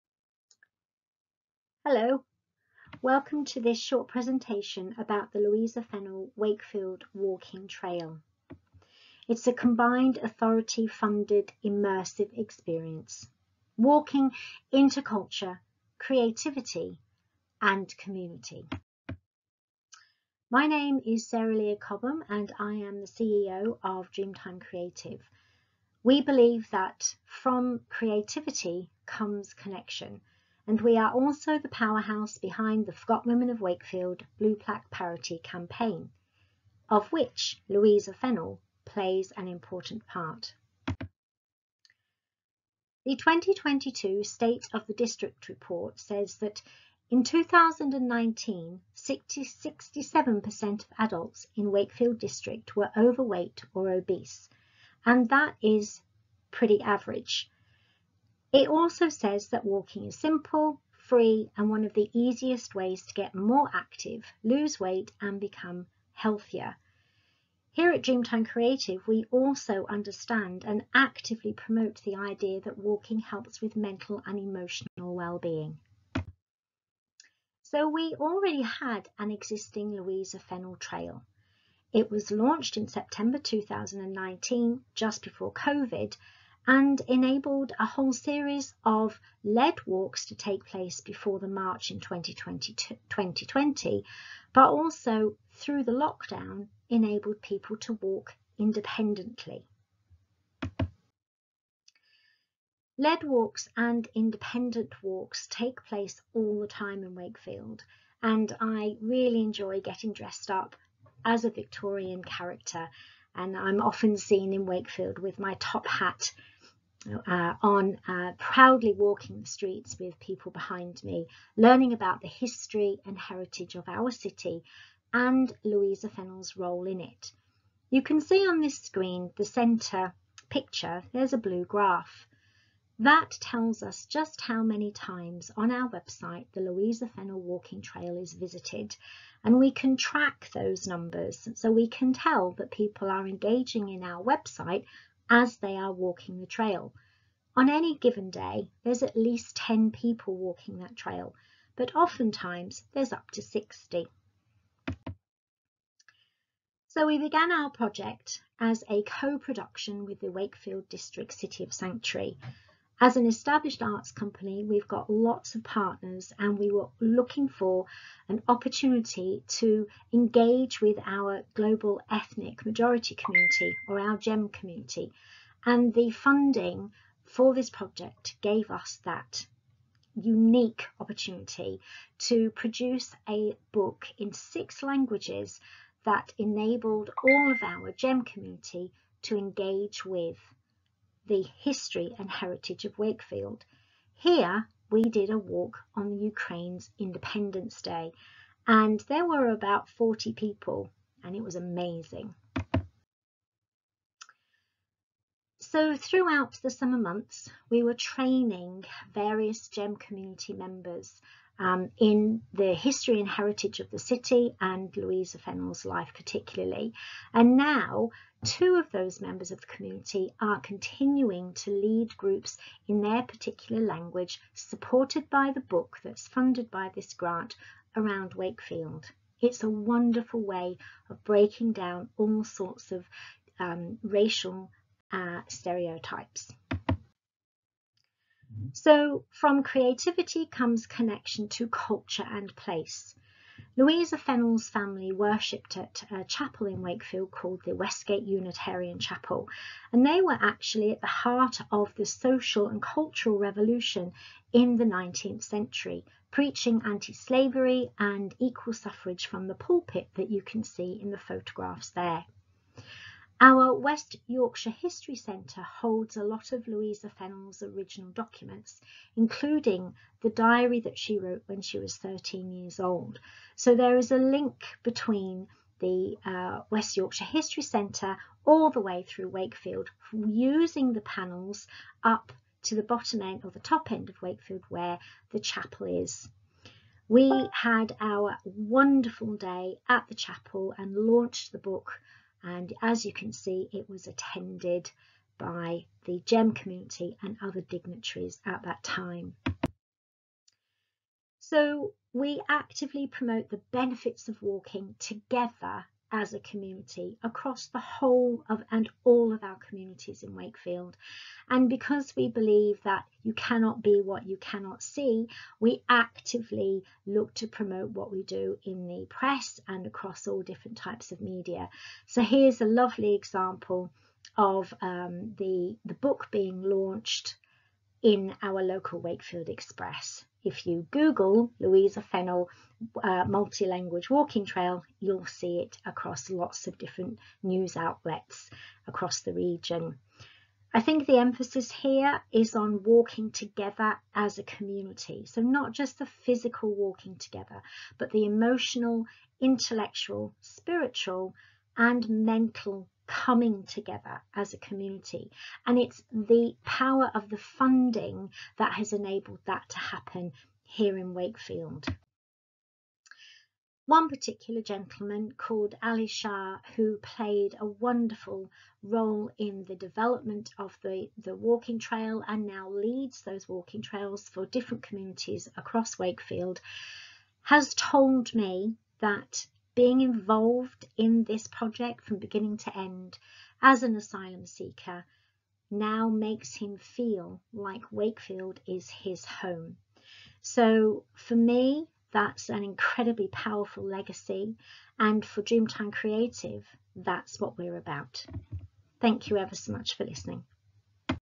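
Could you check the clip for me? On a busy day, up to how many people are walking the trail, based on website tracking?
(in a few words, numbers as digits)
60.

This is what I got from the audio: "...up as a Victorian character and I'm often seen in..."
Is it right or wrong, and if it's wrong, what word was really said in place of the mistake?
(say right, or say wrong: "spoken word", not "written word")
right.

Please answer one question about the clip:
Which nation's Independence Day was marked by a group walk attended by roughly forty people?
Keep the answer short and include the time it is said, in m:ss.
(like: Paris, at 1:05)
Ukraine, at 3:16.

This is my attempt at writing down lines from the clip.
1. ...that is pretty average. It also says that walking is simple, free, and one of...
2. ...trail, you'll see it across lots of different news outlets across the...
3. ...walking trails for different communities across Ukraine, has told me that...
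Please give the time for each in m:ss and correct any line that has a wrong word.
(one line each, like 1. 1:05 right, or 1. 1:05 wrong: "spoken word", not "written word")
1. 0:55 right
2. 5:34 right
3. 6:13 wrong: "Wakefield", not "Ukraine".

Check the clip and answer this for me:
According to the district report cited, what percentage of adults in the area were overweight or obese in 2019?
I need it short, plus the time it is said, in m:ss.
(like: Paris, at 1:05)
67%, at 0:48.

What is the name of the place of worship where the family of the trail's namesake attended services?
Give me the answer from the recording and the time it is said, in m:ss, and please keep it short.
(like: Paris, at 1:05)
Westgate Unitarian Chapel, at 4:07.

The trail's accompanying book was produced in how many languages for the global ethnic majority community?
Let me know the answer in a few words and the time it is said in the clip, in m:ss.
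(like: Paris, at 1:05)
6, at 3:04.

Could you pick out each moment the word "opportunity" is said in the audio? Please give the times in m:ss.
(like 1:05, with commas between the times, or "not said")
2:48, 3:00.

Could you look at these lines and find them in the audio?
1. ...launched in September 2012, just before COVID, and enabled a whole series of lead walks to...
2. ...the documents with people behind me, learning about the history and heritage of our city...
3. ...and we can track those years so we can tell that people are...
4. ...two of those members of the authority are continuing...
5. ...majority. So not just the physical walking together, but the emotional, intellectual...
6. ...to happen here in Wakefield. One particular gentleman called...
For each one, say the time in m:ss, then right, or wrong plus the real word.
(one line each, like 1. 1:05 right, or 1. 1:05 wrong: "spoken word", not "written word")
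1. 1:22 wrong: "2019", not "2012"
2. 1:59 wrong: "streets", not "documents"
3. 2:19 wrong: "numbers", not "years"
4. 3:38 wrong: "community", not "authority"
5. 5:44 wrong: "community", not "majority"
6. 5:59 right.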